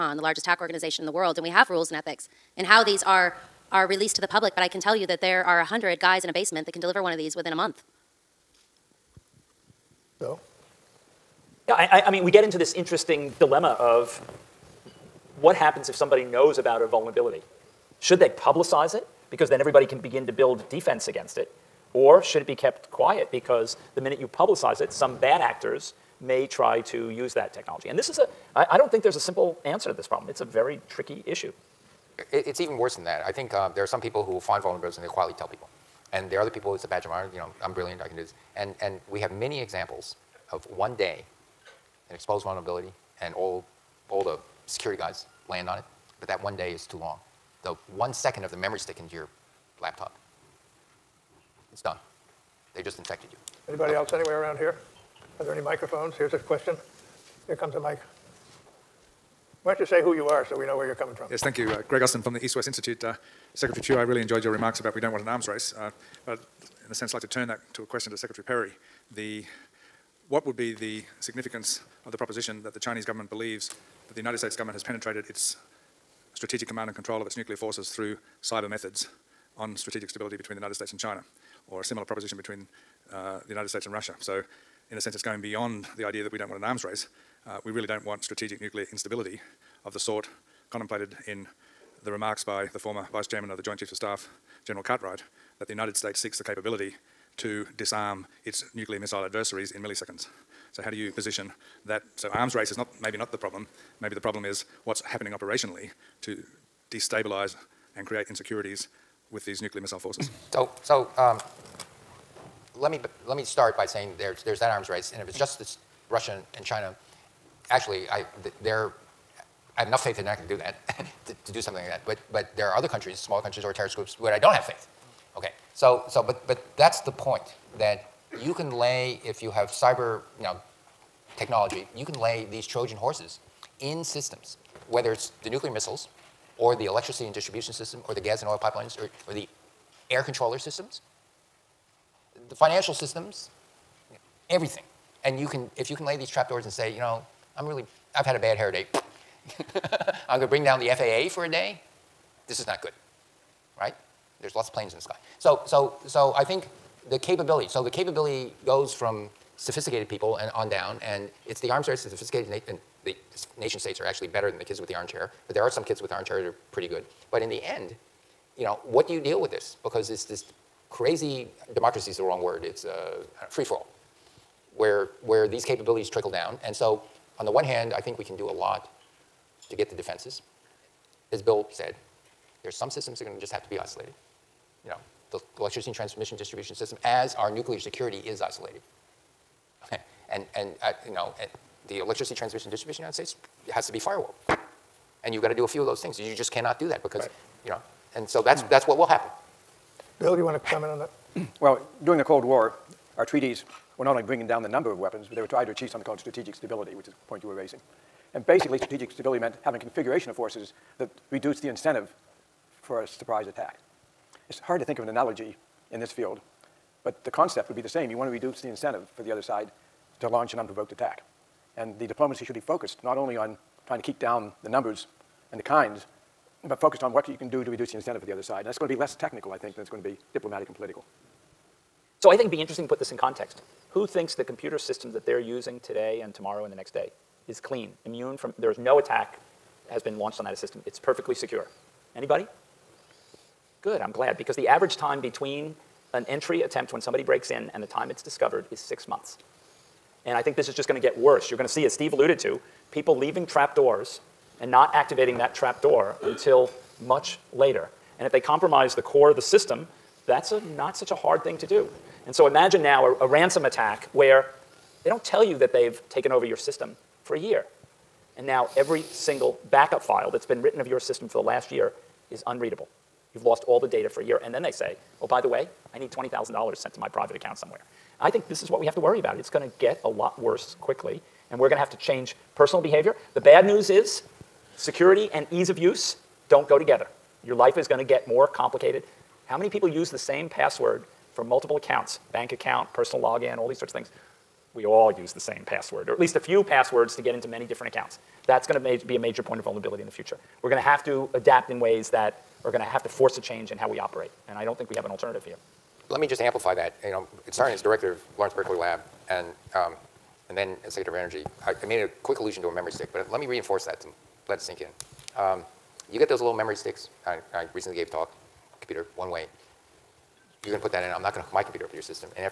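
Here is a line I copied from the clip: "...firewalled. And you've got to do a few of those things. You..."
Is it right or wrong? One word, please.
right.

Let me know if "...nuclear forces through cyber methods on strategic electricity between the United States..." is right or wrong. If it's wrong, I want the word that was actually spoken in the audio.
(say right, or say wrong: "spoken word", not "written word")
wrong: "stability", not "electricity".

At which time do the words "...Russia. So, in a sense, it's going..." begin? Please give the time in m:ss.
1:23.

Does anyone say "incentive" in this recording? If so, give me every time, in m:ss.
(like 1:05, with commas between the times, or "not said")
3:31, 3:38, 3:47.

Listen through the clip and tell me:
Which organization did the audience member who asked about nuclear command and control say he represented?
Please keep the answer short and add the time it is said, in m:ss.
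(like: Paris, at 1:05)
EastWest Institute, at 1:02.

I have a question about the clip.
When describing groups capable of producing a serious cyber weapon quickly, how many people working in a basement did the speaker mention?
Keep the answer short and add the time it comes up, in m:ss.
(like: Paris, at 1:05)
100, at 0:05.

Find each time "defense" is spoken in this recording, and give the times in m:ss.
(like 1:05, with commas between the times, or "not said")
0:20, 2:59.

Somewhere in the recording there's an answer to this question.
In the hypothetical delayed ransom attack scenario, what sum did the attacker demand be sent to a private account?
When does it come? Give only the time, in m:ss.
4:36.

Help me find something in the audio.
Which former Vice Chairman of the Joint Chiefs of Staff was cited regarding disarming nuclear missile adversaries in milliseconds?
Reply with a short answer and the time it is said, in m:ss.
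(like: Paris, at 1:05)
General Cartwright, at 1:34.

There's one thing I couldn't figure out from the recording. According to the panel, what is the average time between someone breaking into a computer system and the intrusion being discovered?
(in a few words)
6 months.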